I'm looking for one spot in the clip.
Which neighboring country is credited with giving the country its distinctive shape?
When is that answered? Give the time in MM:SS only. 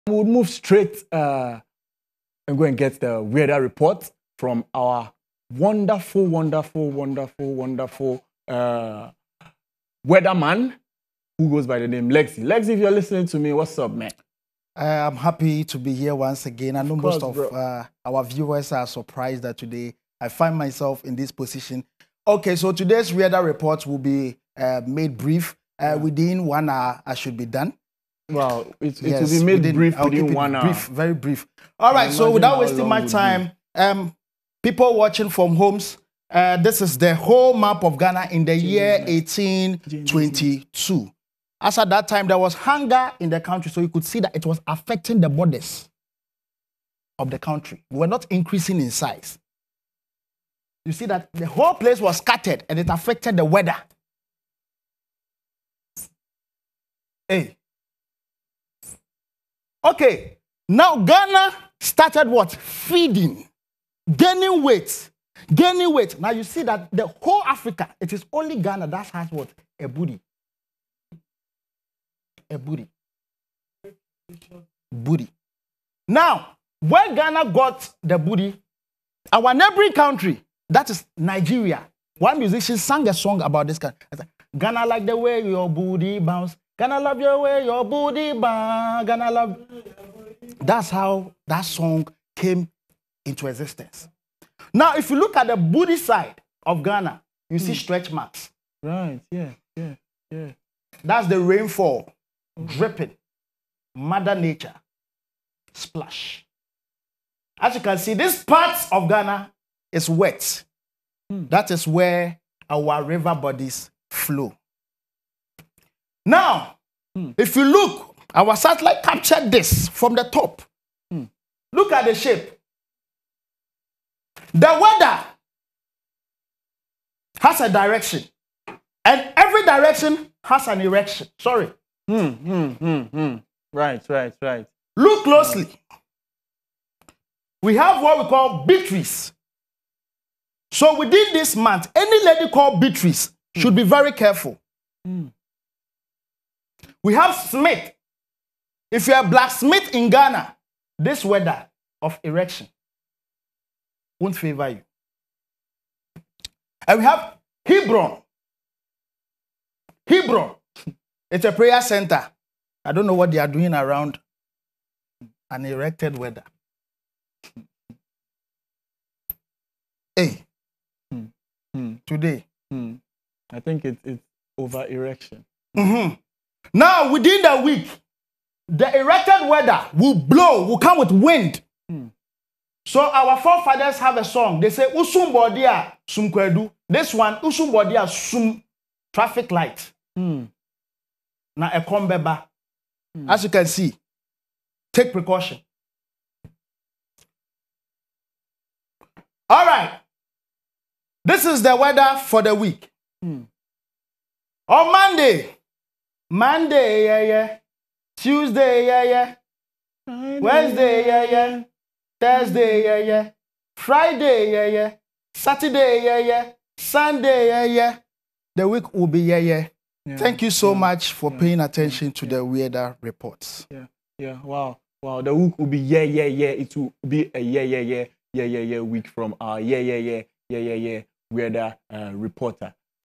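01:21.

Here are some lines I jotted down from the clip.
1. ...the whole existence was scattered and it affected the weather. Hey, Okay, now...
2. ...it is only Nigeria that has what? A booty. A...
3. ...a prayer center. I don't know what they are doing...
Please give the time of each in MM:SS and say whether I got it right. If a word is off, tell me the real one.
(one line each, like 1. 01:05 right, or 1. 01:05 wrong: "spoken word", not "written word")
1. 00:51 wrong: "place", not "existence"
2. 01:07 wrong: "Ghana", not "Nigeria"
3. 02:41 right.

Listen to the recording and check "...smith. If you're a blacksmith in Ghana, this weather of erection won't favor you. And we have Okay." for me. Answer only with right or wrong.
wrong.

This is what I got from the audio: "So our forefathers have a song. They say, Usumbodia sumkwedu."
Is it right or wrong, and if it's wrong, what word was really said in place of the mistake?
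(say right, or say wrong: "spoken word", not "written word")
right.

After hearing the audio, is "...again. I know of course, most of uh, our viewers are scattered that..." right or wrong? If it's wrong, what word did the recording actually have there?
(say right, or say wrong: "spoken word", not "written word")
wrong: "surprised", not "scattered".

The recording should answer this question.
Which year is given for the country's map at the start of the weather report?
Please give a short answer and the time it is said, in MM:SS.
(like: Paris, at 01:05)
1822, at 00:39.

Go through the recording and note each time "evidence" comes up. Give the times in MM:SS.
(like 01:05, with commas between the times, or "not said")
not said.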